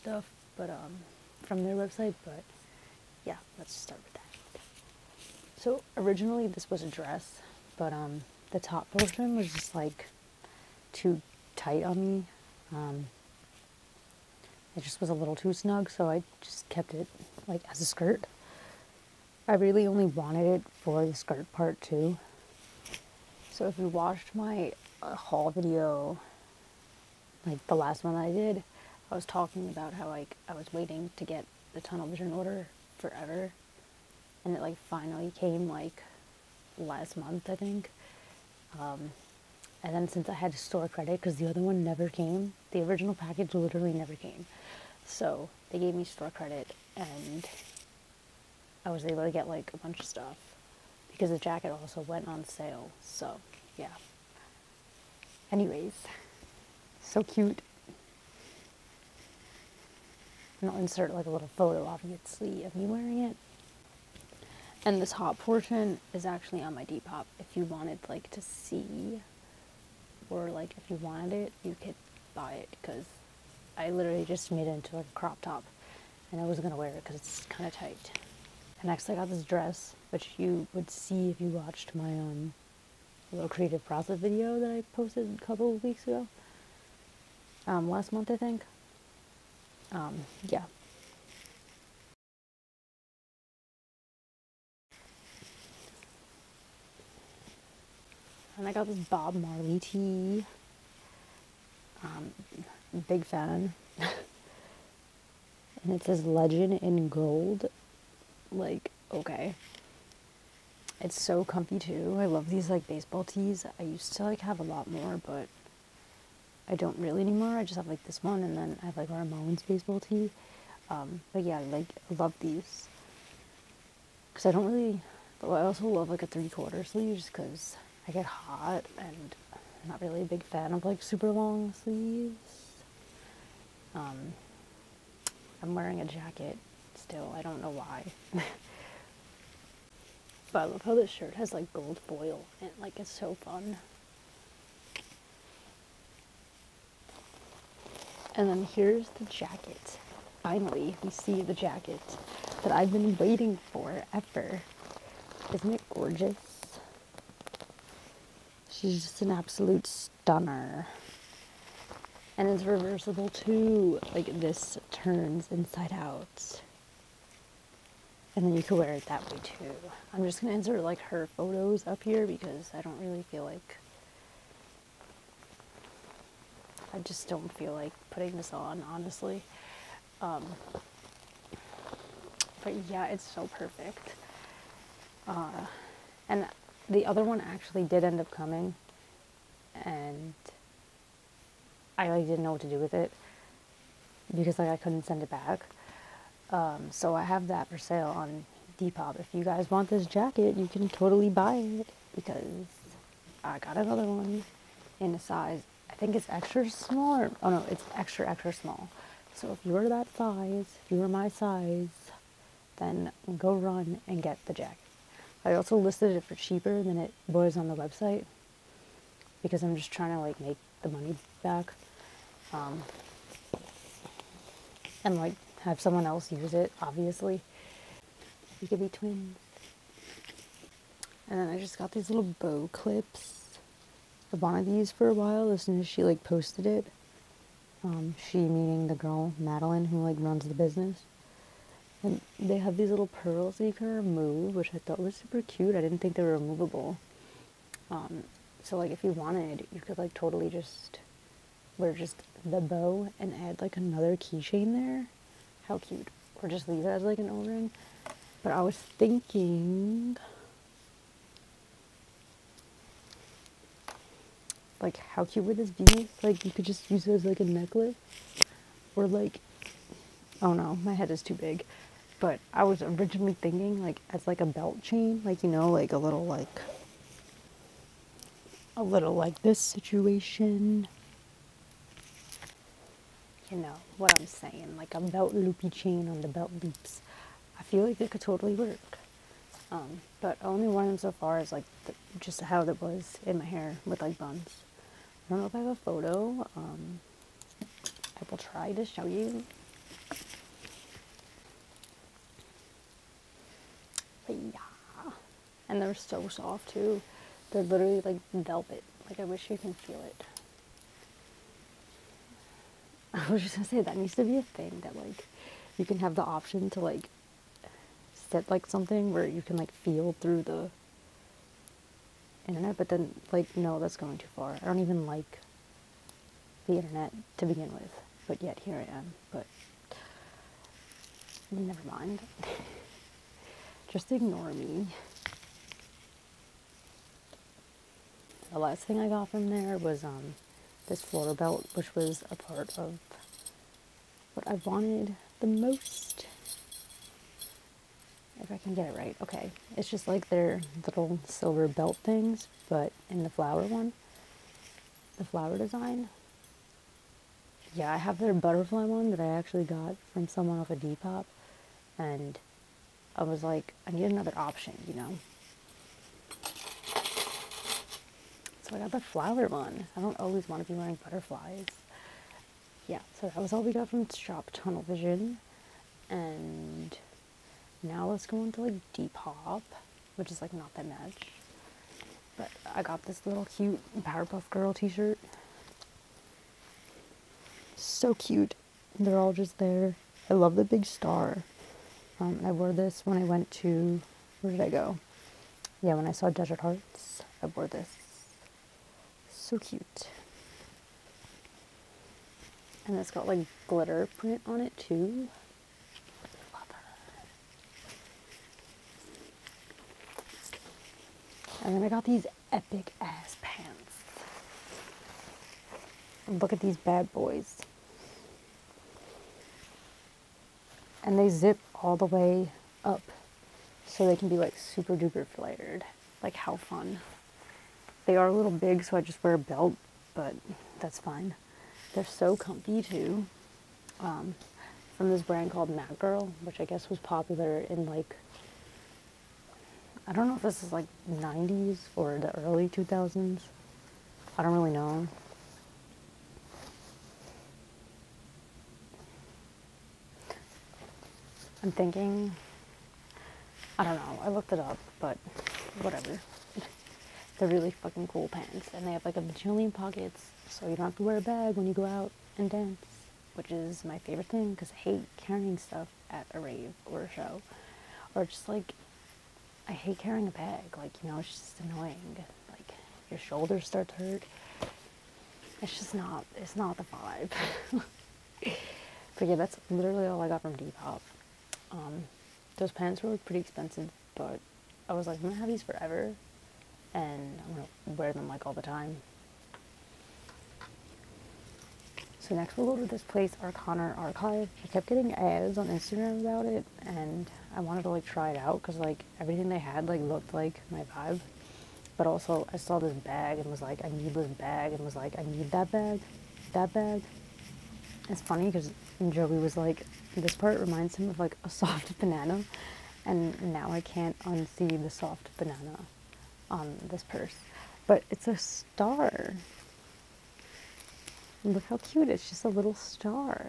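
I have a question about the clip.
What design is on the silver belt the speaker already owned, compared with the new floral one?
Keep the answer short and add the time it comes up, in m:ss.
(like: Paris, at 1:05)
Butterfly, at 5:58.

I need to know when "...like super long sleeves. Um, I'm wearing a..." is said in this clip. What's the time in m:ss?
2:10.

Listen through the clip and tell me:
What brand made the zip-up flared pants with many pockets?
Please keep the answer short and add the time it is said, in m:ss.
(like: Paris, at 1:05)
Matt Girl, at 7:15.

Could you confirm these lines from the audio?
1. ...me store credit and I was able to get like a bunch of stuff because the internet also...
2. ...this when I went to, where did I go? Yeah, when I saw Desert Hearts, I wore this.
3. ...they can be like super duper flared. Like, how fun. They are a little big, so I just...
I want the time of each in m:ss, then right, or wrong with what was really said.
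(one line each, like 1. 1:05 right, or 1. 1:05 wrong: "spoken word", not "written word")
1. 0:45 wrong: "jacket", not "internet"
2. 6:32 right
3. 7:04 right.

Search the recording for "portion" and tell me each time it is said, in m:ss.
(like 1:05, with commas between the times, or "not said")
0:08, 1:05.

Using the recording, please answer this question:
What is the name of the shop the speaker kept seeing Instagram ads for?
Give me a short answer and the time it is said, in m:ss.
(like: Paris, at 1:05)
Arcana Archive, at 8:13.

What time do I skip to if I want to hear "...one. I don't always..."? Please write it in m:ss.
6:09.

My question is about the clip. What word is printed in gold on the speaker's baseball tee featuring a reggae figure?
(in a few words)
Legend.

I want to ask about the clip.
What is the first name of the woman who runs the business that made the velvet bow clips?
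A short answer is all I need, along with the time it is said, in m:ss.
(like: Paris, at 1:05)
Madeline, at 3:59.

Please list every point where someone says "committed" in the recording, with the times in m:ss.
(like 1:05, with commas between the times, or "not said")
not said.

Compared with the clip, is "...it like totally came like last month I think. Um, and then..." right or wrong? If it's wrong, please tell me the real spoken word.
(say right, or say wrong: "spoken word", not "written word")
wrong: "finally", not "totally".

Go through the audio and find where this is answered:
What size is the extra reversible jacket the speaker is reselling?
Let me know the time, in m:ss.
3:27.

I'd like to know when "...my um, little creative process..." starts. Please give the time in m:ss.
1:21.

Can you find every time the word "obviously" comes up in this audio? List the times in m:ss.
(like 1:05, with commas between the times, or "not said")
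1:01, 3:46.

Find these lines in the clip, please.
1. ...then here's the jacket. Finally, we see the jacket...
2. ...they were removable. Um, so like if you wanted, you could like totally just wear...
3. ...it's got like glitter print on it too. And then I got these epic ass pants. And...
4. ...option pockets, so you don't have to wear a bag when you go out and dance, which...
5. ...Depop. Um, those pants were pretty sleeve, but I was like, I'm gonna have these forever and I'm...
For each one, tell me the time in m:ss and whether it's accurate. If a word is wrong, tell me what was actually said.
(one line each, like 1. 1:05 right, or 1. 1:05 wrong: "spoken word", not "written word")
1. 2:28 right
2. 4:06 right
3. 6:42 right
4. 7:39 wrong: "bajillion", not "option"
5. 8:00 wrong: "expensive", not "sleeve".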